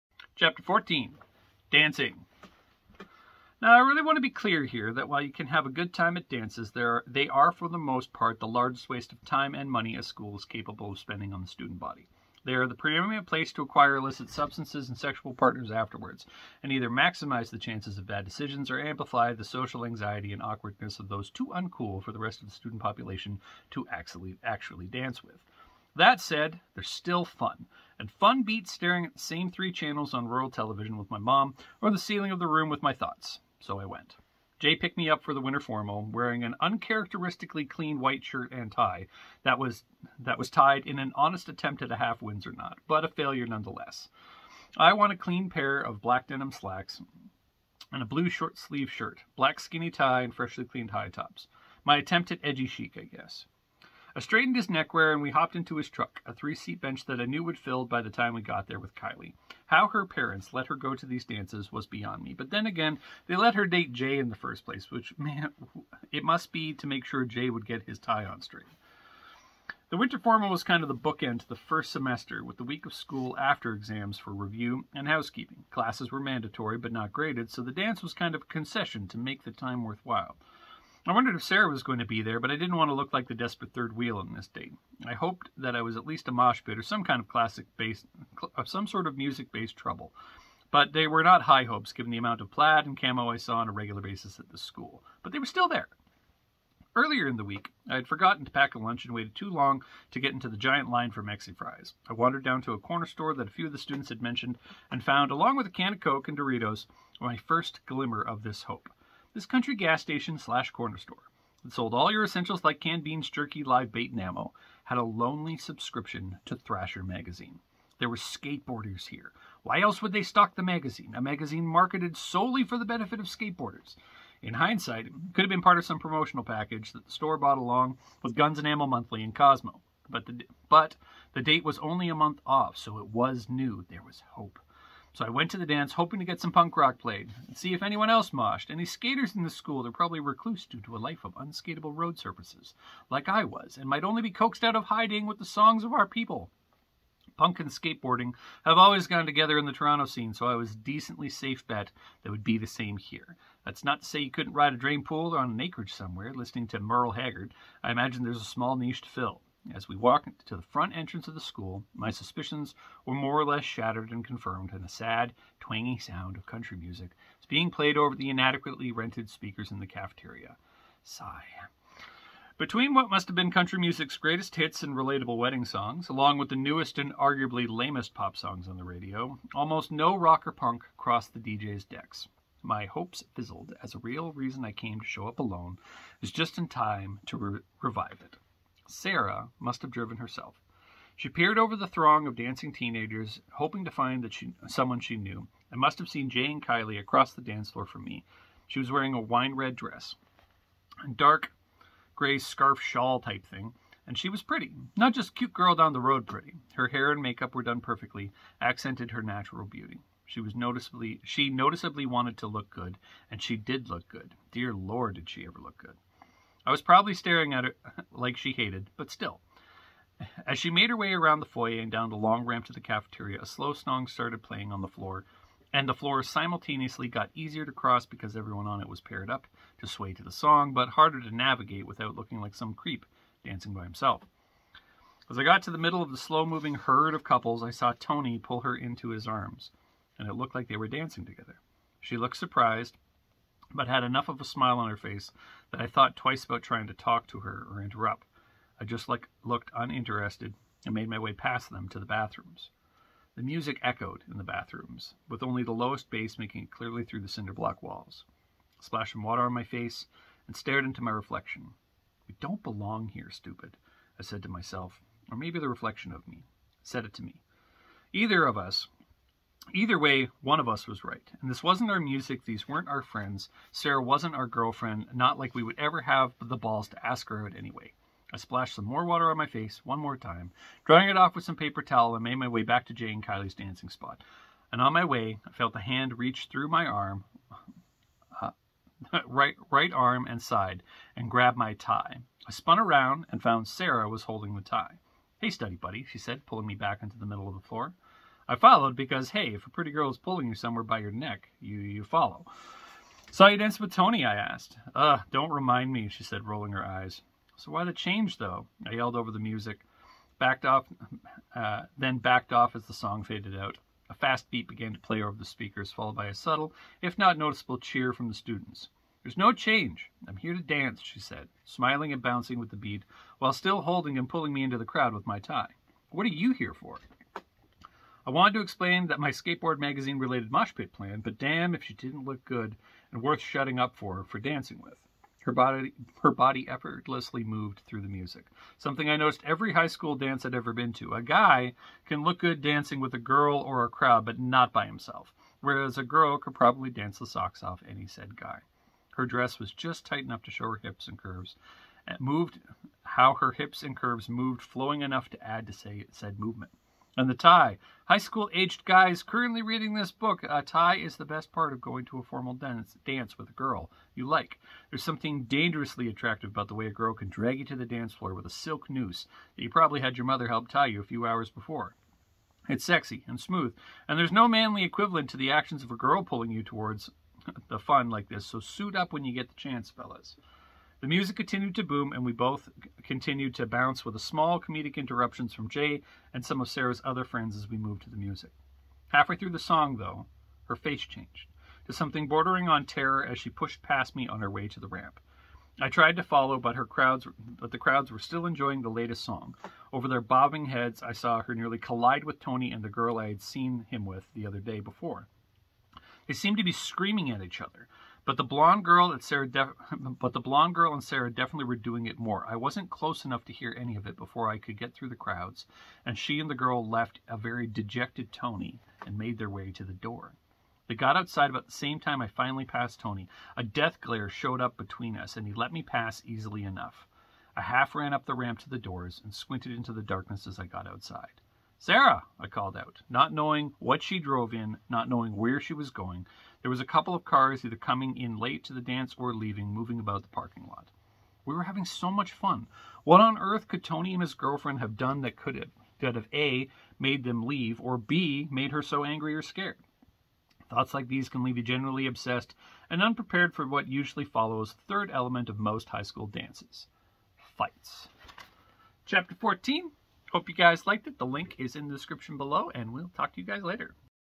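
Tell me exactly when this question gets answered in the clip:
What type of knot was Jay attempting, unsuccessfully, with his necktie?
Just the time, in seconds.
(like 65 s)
41 s.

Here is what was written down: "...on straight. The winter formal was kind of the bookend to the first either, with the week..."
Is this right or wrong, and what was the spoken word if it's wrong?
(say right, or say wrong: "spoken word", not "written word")
wrong: "semester", not "either".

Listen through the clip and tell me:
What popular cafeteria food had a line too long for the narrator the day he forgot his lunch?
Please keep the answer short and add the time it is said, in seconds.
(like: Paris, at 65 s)
Mexi Fries, at 101 s.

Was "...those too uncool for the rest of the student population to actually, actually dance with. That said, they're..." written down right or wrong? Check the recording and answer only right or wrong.
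right.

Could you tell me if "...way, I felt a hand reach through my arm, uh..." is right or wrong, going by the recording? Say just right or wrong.
right.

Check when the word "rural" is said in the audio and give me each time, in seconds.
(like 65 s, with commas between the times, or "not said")
30 s.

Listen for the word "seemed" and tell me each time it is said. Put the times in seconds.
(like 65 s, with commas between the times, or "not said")
406 s.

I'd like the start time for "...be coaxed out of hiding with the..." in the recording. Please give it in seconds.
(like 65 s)
144 s.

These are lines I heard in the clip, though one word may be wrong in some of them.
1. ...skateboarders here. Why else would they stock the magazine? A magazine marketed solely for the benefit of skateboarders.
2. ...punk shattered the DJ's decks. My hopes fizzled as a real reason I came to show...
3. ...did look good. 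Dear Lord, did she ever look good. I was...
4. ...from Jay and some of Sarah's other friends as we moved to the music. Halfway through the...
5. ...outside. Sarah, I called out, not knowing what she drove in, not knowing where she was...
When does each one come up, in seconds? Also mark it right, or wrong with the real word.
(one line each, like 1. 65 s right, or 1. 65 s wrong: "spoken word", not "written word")
1. 118 s right
2. 180 s wrong: "crossed", not "shattered"
3. 213 s right
4. 385 s right
5. 430 s right.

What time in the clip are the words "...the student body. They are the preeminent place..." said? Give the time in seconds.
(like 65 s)
11 s.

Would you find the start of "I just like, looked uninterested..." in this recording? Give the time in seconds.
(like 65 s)
248 s.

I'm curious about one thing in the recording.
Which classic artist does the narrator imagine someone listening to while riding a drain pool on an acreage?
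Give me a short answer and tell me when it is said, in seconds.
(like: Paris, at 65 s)
Merle Haggard, at 156 s.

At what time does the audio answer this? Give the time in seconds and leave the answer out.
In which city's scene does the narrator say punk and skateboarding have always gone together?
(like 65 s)
149 s.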